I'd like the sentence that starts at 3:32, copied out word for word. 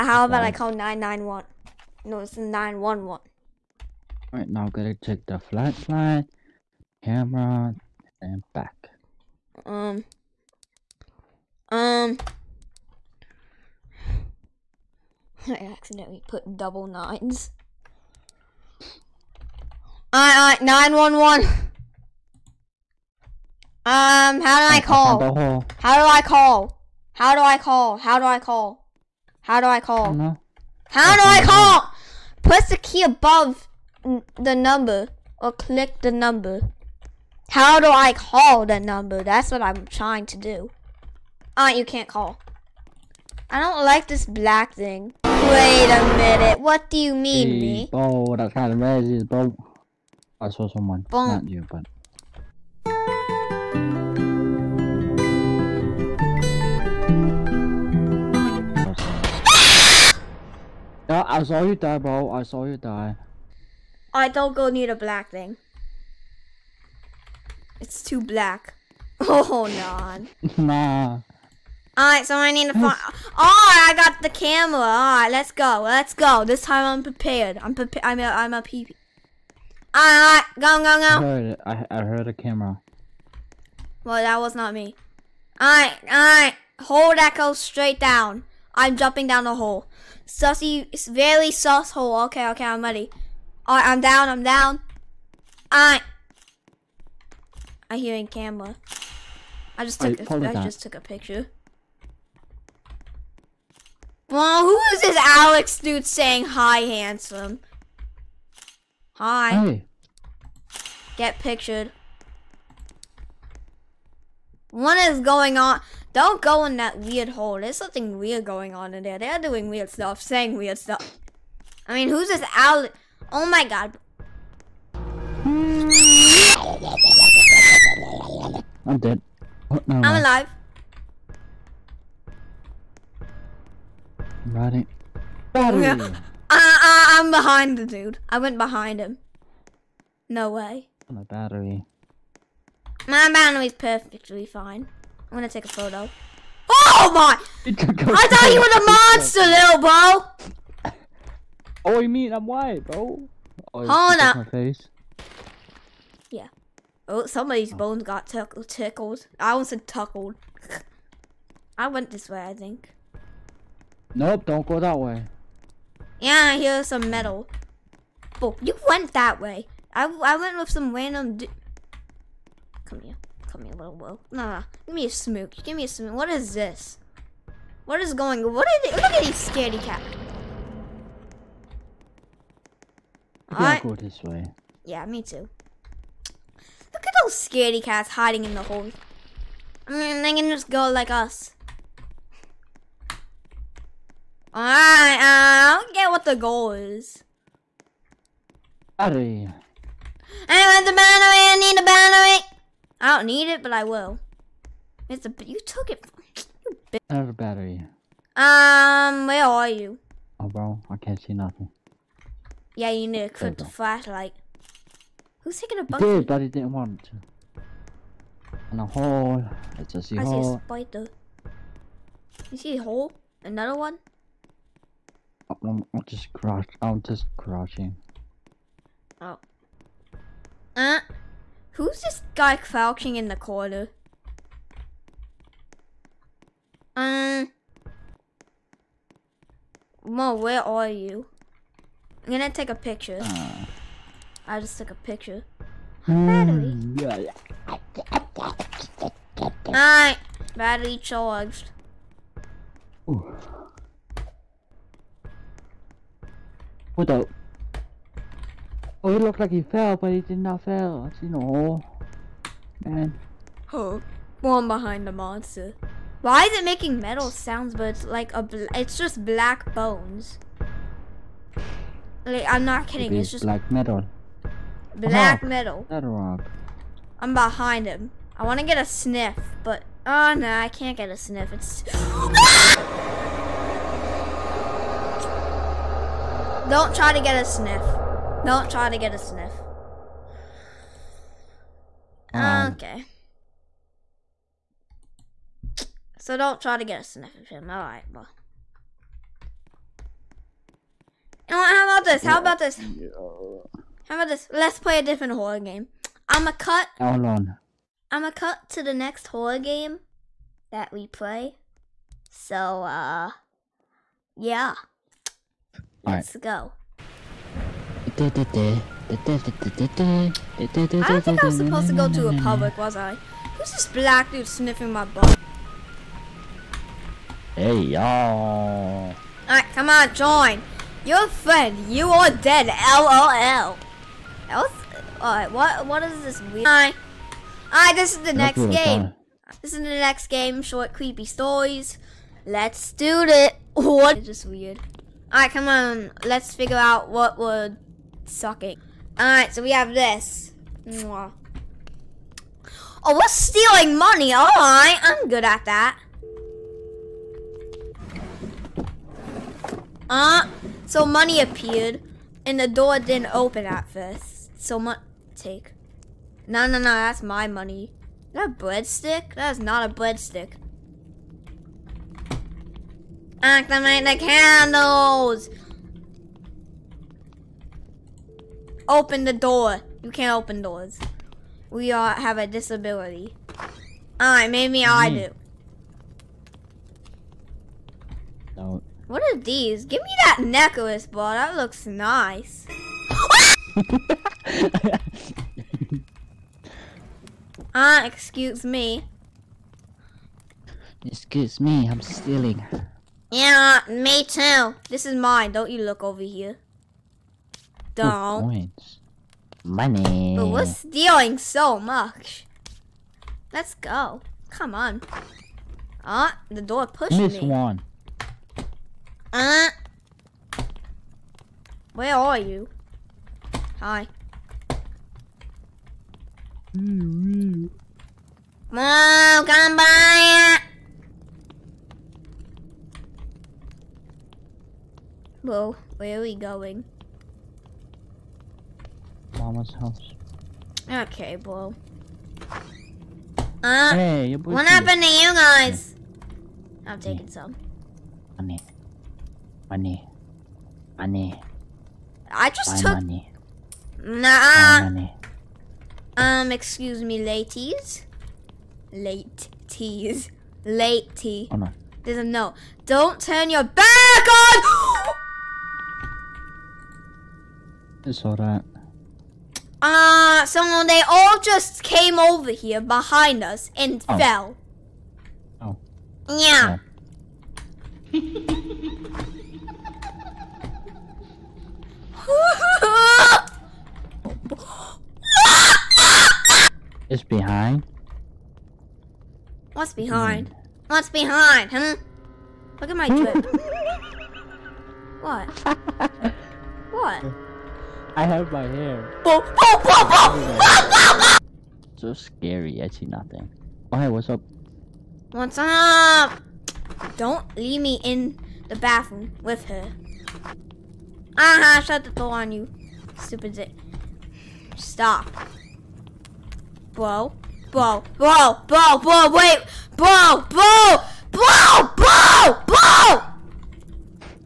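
Yeah, you need to equip the flashlight.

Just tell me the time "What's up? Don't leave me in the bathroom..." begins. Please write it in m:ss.
8:25.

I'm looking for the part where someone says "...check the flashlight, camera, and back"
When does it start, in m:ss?
0:05.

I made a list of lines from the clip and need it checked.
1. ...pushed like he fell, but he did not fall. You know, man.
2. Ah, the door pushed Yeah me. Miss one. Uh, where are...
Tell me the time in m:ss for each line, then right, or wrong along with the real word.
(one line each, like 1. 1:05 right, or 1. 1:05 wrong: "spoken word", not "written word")
1. 4:19 wrong: "looked", not "pushed"
2. 6:56 wrong: "Miss", not "Yeah".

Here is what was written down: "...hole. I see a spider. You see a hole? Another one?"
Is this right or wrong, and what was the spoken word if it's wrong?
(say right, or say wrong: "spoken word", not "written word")
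right.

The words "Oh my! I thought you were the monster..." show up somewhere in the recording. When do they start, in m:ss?
2:26.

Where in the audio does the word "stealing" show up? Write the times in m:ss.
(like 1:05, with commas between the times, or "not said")
5:53, 6:42, 6:50.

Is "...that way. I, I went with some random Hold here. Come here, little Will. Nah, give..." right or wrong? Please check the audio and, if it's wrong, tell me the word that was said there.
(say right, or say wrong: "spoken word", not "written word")
wrong: "Come", not "Hold".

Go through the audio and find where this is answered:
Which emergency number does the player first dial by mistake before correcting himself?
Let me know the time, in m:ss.
0:00.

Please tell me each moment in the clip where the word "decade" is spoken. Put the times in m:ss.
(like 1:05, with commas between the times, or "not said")
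not said.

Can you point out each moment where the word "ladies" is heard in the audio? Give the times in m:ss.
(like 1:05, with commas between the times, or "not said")
7:37.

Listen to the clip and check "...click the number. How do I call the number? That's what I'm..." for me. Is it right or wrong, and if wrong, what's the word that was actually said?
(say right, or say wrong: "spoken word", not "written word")
right.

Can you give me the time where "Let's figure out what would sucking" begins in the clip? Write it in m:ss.
5:46.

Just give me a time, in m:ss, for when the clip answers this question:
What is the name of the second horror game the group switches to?
5:40.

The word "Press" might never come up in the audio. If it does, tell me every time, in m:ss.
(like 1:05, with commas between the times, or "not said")
0:32.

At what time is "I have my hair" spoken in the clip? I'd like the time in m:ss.
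8:18.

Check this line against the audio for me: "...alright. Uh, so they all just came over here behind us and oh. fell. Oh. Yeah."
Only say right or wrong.
right.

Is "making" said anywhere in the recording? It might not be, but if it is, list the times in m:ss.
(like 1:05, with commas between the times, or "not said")
4:26.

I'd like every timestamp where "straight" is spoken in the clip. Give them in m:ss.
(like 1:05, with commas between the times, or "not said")
1:27.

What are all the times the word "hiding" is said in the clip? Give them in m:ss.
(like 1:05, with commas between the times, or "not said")
3:08.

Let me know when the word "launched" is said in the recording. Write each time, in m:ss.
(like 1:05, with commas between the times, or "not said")
not said.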